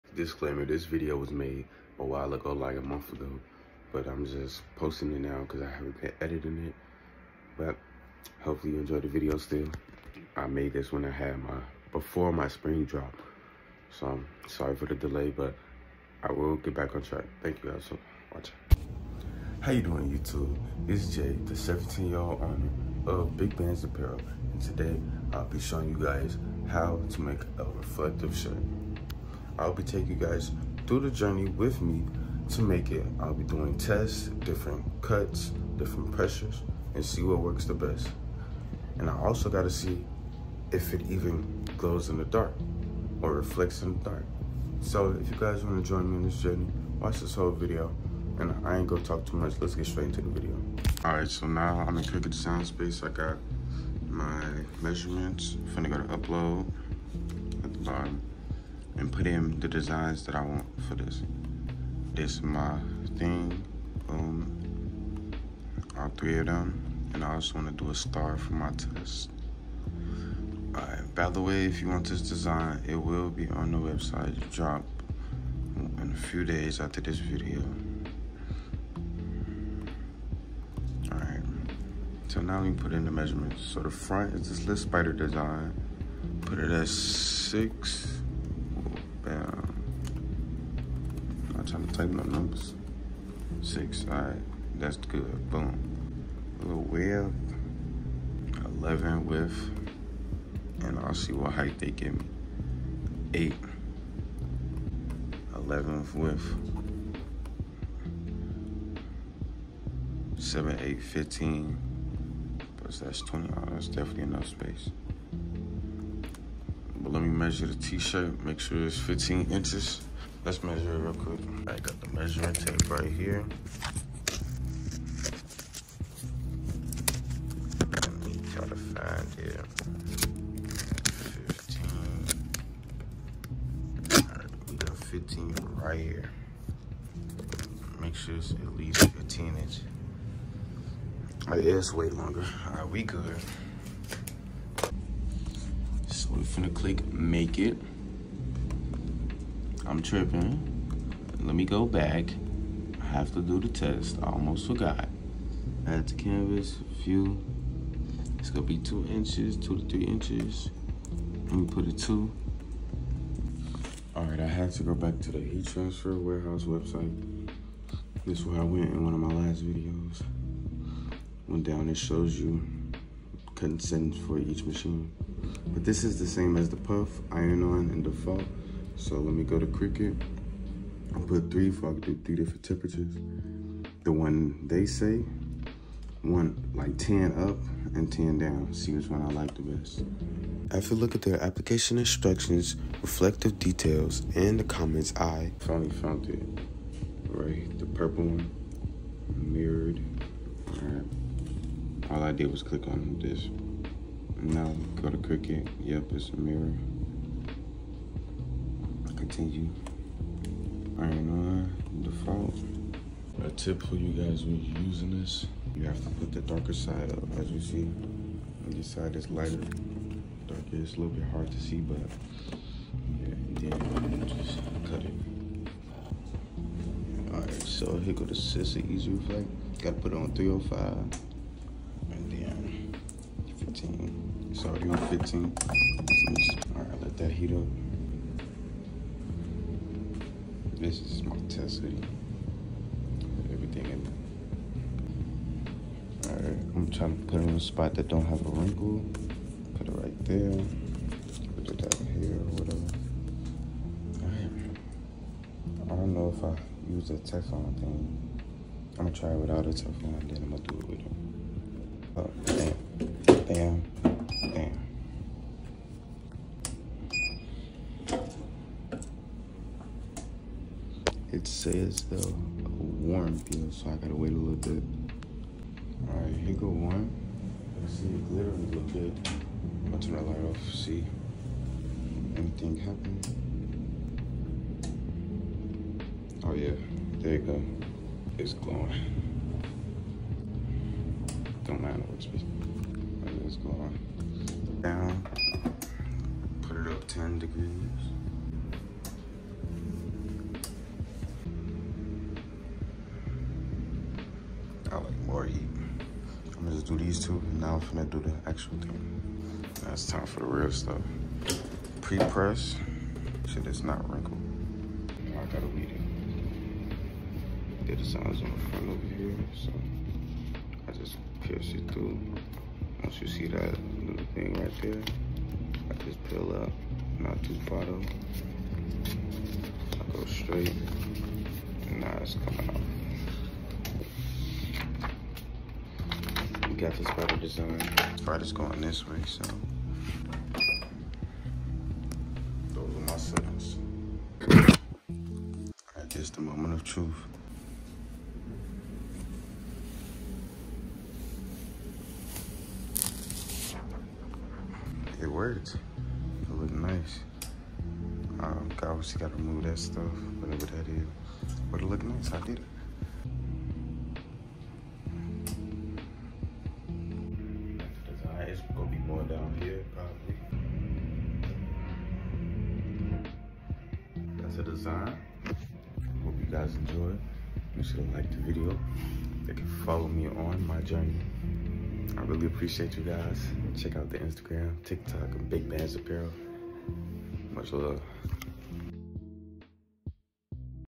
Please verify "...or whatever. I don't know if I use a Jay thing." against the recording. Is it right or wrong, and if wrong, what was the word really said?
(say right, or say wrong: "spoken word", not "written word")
wrong: "Teflon", not "Jay".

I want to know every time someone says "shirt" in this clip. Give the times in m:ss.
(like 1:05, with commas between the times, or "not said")
0:28, 1:57.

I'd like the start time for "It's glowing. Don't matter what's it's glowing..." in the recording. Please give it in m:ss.
4:48.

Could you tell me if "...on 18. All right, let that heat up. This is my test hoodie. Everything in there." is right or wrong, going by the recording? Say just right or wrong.
wrong.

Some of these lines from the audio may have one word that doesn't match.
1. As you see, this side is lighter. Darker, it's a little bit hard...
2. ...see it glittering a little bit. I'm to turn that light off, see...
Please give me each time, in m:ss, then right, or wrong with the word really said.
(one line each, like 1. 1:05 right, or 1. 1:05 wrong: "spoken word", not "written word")
1. 3:37 right
2. 4:37 right.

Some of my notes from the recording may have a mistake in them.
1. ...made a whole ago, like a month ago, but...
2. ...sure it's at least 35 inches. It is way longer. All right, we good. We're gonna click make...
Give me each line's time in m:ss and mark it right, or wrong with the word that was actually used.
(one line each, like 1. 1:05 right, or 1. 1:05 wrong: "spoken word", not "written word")
1. 0:01 wrong: "while", not "whole"
2. 2:18 wrong: "15", not "35".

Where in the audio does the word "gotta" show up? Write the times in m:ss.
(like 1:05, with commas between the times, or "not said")
0:39, 3:49, 4:33, 5:15.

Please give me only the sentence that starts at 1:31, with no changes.
I'm not trying to type no numbers.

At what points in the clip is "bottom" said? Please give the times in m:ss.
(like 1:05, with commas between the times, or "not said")
0:57.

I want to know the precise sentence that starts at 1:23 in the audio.
So the front is this little spider design.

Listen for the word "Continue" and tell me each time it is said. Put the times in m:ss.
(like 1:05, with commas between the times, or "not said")
3:29.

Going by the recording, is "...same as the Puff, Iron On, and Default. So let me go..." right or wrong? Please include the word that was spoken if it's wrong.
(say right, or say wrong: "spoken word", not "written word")
right.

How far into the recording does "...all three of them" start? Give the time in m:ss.
1:05.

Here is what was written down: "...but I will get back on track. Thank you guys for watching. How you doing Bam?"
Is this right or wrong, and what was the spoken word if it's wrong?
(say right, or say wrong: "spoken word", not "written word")
wrong: "YouTube", not "Bam".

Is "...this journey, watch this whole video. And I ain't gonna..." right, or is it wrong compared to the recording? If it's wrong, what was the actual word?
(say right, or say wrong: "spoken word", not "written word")
right.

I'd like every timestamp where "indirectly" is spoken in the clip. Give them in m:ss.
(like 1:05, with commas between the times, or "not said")
not said.